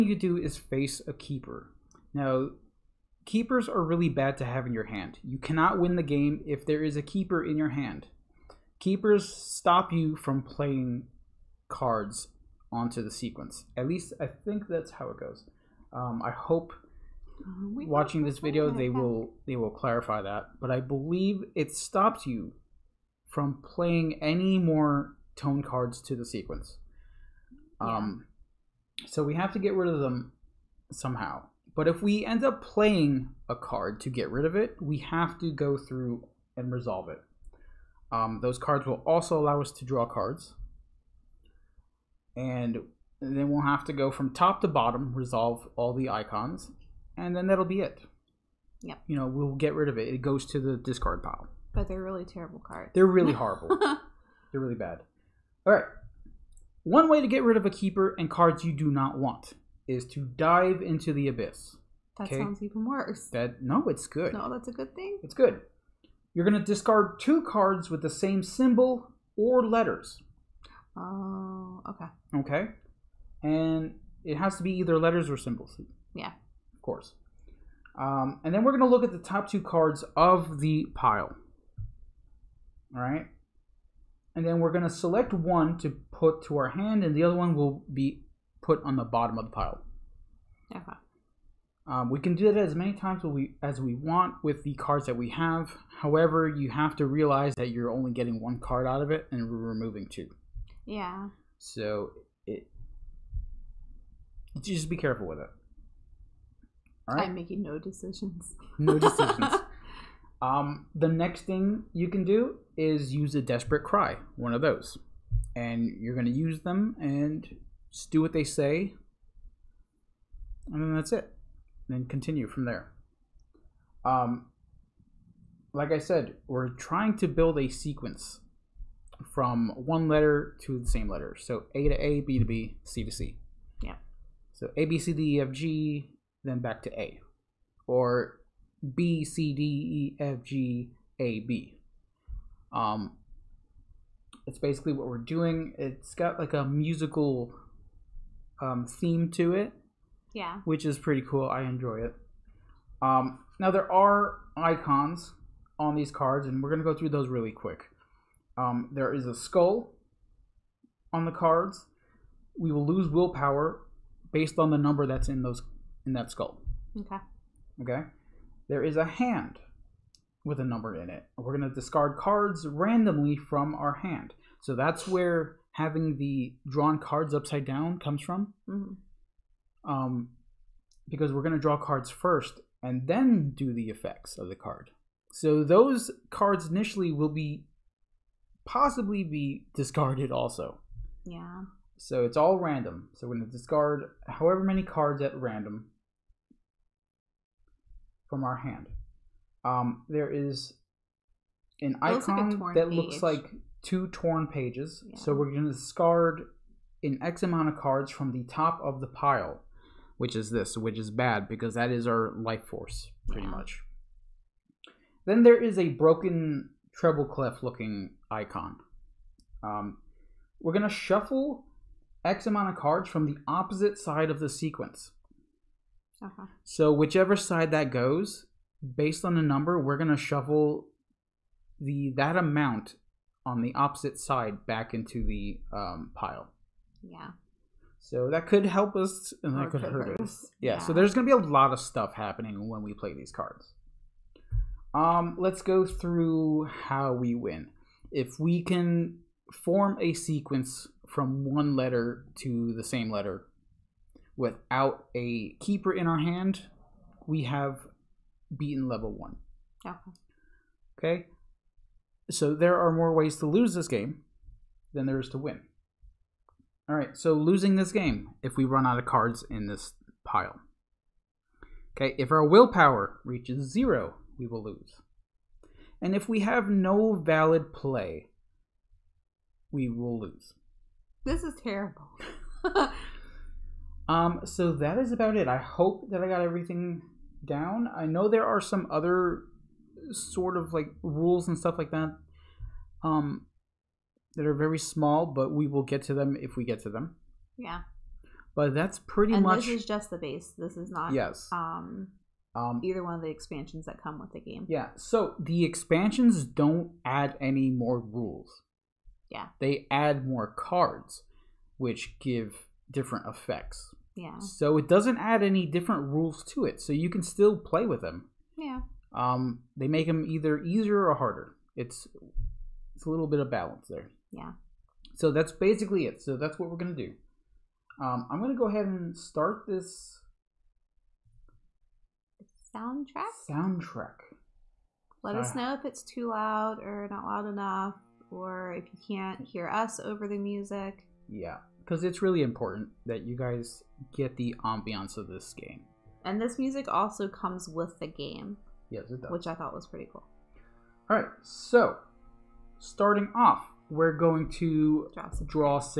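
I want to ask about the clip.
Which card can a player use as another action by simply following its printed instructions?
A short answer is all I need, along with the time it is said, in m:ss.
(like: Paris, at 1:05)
Desperate cry, at 1:53.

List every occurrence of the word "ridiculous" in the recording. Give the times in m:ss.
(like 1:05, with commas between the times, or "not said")
not said.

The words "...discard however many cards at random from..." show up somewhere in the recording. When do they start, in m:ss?
3:13.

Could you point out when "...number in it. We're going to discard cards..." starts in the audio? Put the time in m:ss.
2:50.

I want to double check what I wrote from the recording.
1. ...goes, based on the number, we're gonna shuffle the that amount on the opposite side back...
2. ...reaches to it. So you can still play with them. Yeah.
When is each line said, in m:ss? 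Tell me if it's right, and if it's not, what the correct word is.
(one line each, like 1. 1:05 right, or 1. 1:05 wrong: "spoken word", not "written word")
1. 3:47 right
2. 5:16 wrong: "rules", not "reaches".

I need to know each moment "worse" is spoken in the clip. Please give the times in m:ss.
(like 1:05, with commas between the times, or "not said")
1:02.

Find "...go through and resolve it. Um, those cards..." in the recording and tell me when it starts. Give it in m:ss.
0:35.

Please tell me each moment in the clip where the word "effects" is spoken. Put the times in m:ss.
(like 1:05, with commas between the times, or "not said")
3:03, 5:13.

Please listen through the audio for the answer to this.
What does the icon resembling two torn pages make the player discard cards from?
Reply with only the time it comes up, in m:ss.
3:28.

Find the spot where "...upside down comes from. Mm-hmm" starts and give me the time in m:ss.
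2:57.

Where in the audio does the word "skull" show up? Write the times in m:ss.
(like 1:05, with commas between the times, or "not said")
2:39, 2:46.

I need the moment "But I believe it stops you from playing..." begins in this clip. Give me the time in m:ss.
0:20.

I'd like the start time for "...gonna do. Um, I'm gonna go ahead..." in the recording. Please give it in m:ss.
5:26.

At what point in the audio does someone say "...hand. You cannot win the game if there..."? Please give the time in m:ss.
0:04.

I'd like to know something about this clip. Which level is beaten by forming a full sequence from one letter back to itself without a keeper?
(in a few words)
Level 1.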